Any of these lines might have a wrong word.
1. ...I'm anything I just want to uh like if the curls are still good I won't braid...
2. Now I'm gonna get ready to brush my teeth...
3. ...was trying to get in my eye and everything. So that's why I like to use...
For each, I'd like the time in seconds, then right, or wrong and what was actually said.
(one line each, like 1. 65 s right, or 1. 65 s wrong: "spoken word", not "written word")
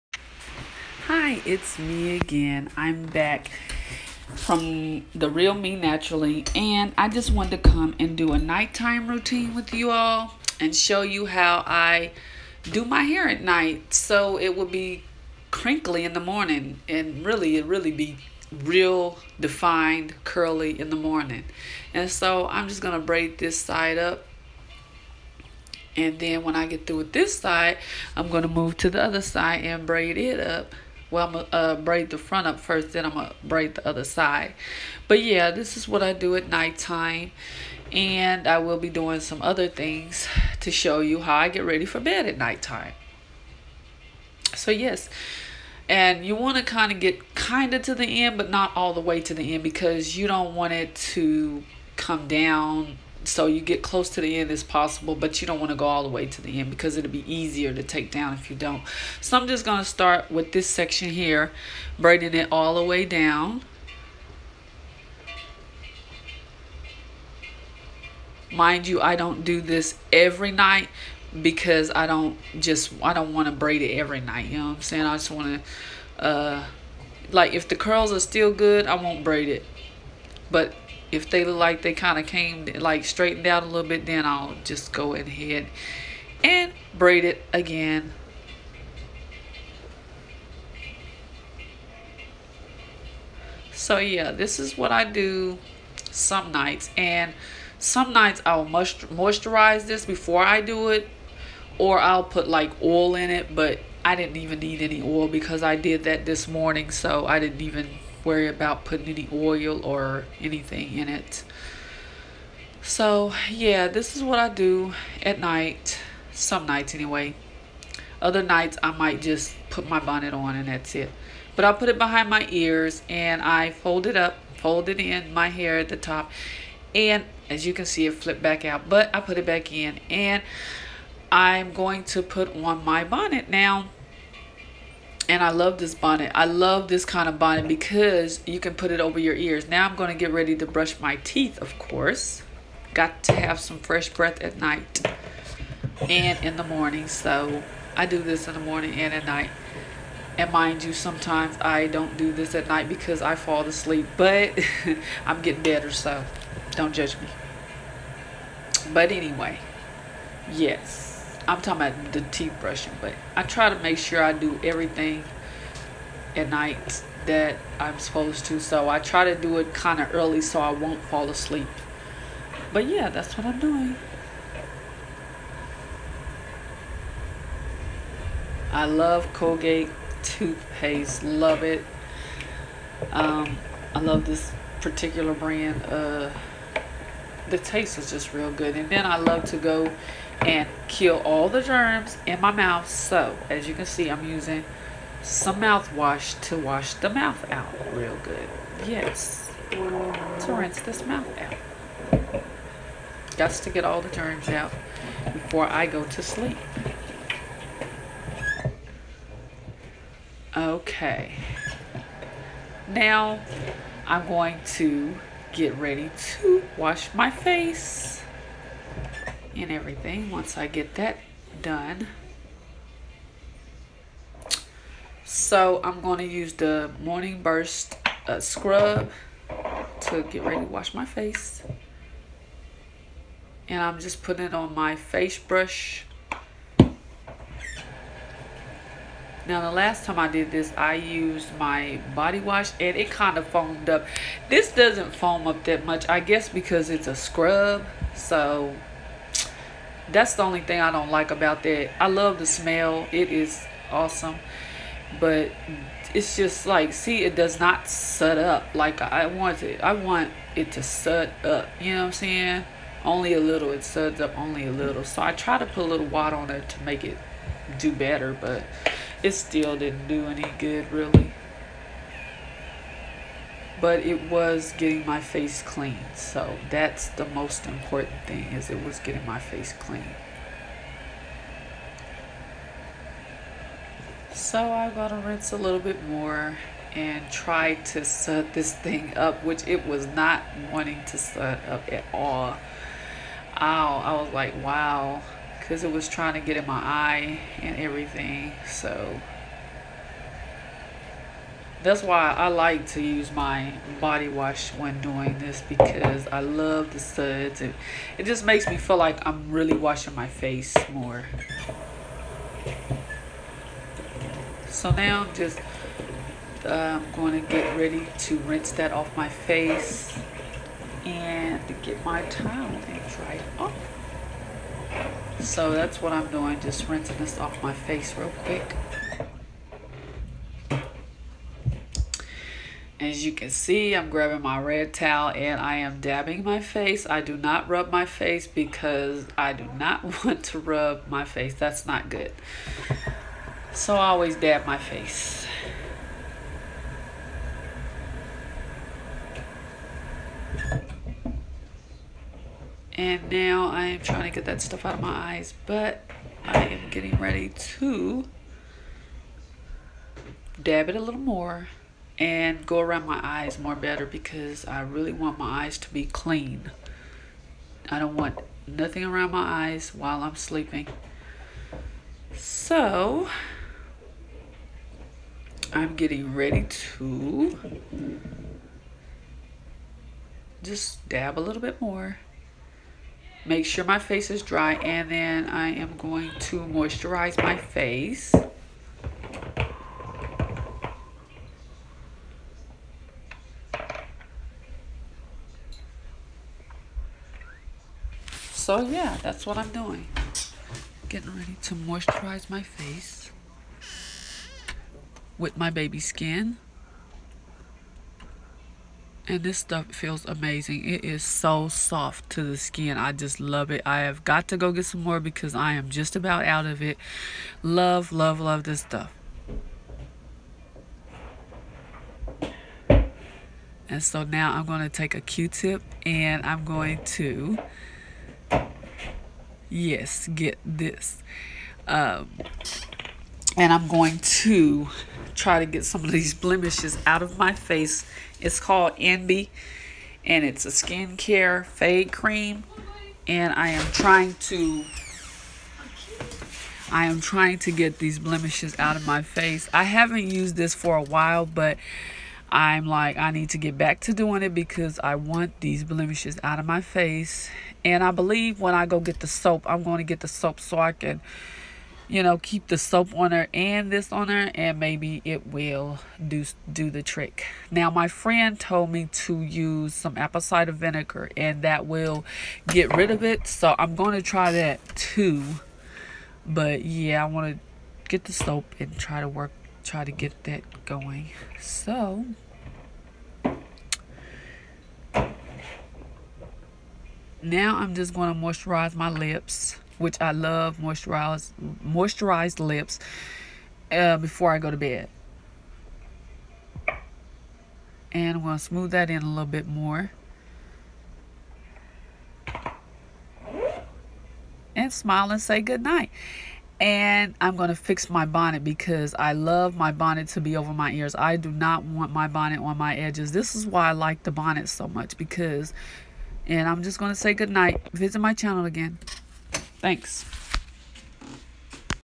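1. 74 s wrong: "saying", not "anything"
2. 139 s right
3. 295 s right.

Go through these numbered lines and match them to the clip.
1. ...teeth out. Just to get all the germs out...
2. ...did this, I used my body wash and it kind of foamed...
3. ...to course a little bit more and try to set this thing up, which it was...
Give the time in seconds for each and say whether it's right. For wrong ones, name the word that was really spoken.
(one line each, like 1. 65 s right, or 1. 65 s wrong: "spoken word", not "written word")
1. 201 s wrong: "mouth", not "teeth"
2. 240 s right
3. 285 s wrong: "rinse", not "course".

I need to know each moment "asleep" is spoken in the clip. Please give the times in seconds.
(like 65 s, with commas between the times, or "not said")
153 s, 171 s.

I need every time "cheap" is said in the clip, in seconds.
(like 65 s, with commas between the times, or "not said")
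not said.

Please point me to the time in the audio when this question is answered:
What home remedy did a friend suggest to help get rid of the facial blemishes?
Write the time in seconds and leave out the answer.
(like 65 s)
470 s.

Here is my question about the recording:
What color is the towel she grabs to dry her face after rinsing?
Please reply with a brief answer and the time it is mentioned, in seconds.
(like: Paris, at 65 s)
Red, at 334 s.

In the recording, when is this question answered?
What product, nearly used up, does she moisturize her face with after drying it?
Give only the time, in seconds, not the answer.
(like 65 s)
405 s.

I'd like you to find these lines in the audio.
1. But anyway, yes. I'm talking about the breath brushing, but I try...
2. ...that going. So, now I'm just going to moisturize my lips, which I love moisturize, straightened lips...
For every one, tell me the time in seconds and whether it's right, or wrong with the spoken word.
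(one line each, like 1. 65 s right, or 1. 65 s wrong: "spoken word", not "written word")
1. 158 s wrong: "teeth", not "breath"
2. 480 s wrong: "moisturized", not "straightened".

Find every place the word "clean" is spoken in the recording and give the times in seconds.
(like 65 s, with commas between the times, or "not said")
275 s, 279 s, 366 s.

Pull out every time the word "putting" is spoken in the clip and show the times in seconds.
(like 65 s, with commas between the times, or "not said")
108 s, 234 s.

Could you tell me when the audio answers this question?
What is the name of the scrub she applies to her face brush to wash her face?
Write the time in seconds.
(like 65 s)
227 s.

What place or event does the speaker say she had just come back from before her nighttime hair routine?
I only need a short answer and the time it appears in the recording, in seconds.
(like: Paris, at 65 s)
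The Real Me Naturally, at 5 s.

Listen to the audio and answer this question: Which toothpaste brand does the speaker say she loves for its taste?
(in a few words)
Colgate.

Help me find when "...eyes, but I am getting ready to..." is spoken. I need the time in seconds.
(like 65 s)
355 s.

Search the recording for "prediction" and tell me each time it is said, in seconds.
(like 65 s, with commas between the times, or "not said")
not said.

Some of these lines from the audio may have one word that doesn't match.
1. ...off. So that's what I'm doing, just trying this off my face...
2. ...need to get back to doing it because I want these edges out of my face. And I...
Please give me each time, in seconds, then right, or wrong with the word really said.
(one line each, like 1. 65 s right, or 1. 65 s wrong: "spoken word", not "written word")
1. 323 s wrong: "rinsing", not "trying"
2. 453 s wrong: "blemishes", not "edges".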